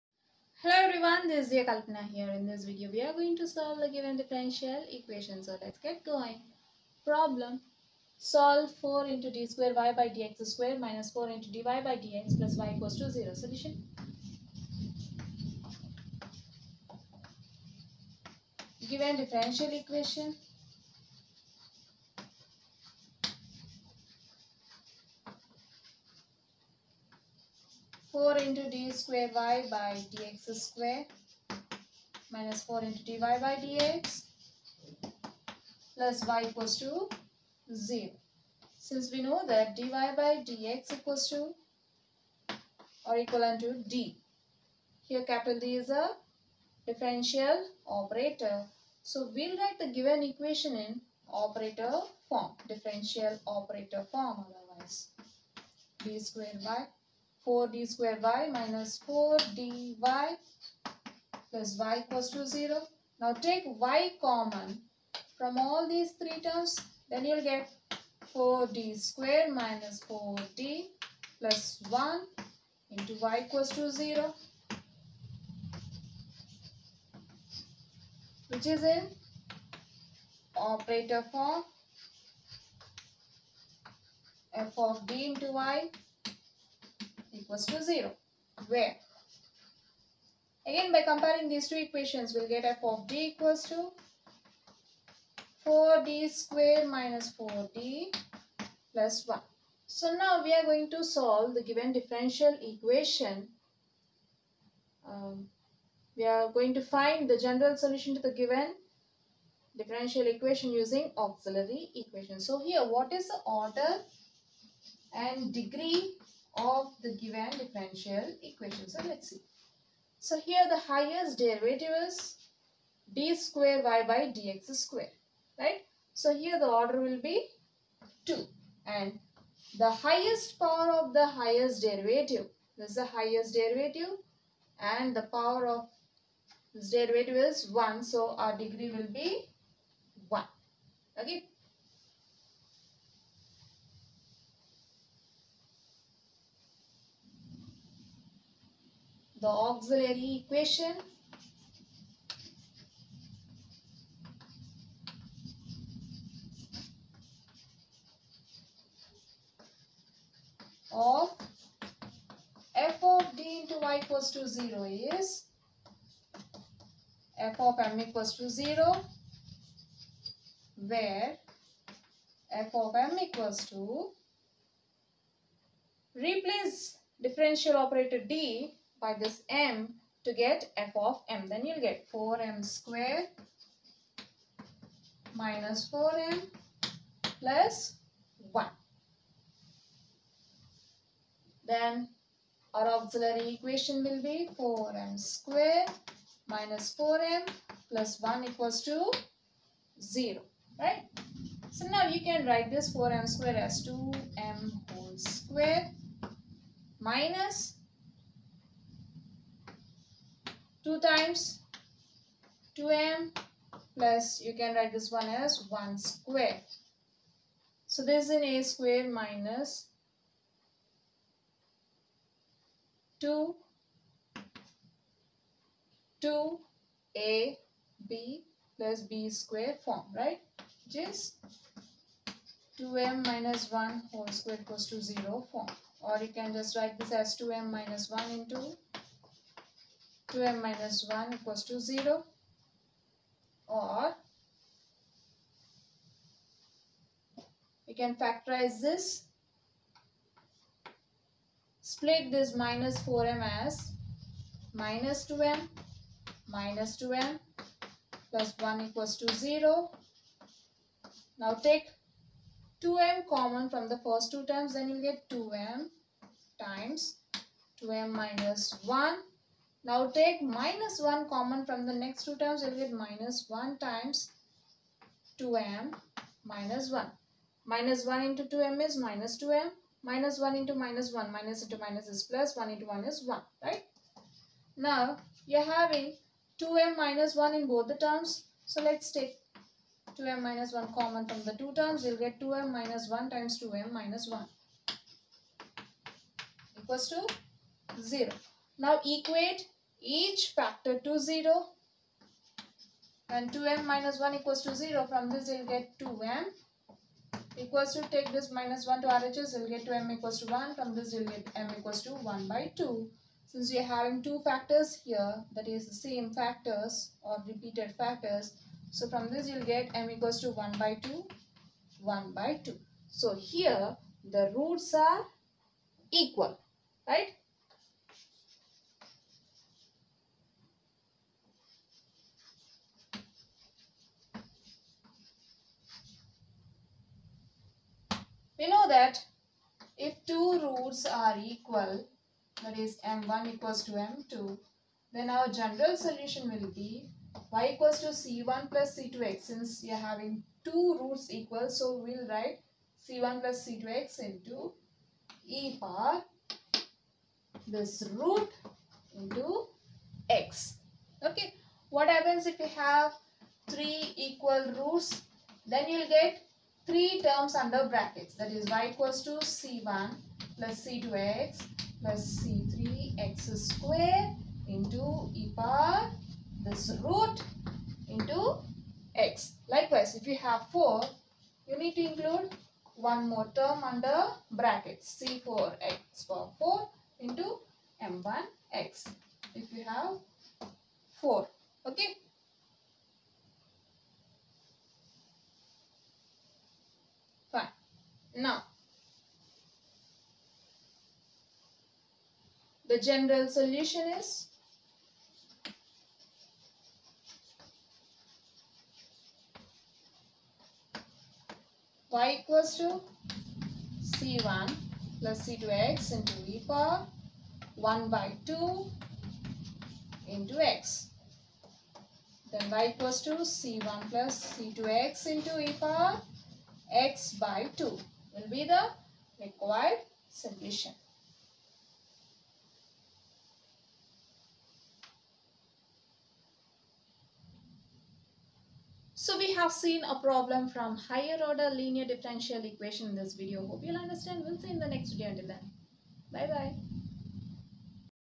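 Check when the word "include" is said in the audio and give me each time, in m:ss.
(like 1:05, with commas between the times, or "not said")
6:22.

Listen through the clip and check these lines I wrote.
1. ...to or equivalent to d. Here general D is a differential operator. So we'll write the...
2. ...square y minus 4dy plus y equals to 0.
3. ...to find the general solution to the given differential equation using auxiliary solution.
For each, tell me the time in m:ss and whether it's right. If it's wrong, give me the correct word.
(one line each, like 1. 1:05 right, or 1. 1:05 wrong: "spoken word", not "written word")
1. 0:41 wrong: "capital", not "general"
2. 0:57 right
3. 1:46 wrong: "equation", not "solution".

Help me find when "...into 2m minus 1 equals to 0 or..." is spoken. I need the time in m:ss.
3:58.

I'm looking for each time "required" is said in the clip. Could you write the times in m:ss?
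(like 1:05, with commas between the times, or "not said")
7:09.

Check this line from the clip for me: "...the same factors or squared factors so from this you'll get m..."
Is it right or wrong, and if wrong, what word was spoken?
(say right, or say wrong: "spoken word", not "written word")
wrong: "repeated", not "squared".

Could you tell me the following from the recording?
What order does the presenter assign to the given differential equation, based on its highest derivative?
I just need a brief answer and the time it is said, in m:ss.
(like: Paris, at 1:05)
2, at 2:06.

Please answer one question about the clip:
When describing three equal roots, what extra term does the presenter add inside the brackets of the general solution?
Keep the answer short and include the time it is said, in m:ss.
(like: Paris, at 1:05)
c3x², at 6:12.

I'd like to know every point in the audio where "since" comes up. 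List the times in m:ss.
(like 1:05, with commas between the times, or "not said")
0:38, 5:13, 5:49.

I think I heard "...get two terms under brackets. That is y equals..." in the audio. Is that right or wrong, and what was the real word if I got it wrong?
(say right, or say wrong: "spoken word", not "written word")
wrong: "three", not "two".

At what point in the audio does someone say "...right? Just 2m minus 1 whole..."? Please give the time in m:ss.
3:50.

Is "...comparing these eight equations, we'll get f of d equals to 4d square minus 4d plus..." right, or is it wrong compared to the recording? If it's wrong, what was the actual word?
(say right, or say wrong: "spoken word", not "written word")
wrong: "two", not "eight".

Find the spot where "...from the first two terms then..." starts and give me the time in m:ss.
4:23.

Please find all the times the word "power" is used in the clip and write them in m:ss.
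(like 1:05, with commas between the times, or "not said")
2:10, 2:15, 5:55, 6:15, 6:26, 6:56, 7:05.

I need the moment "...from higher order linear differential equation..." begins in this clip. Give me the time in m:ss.
7:20.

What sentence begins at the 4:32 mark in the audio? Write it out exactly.
You'll get minus 1 times 2m minus 1.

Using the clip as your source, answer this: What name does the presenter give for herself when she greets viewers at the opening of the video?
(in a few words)
Kalpana.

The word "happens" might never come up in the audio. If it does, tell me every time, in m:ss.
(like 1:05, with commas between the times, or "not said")
6:02.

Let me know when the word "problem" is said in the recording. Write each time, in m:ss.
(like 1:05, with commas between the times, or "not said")
0:07, 7:20.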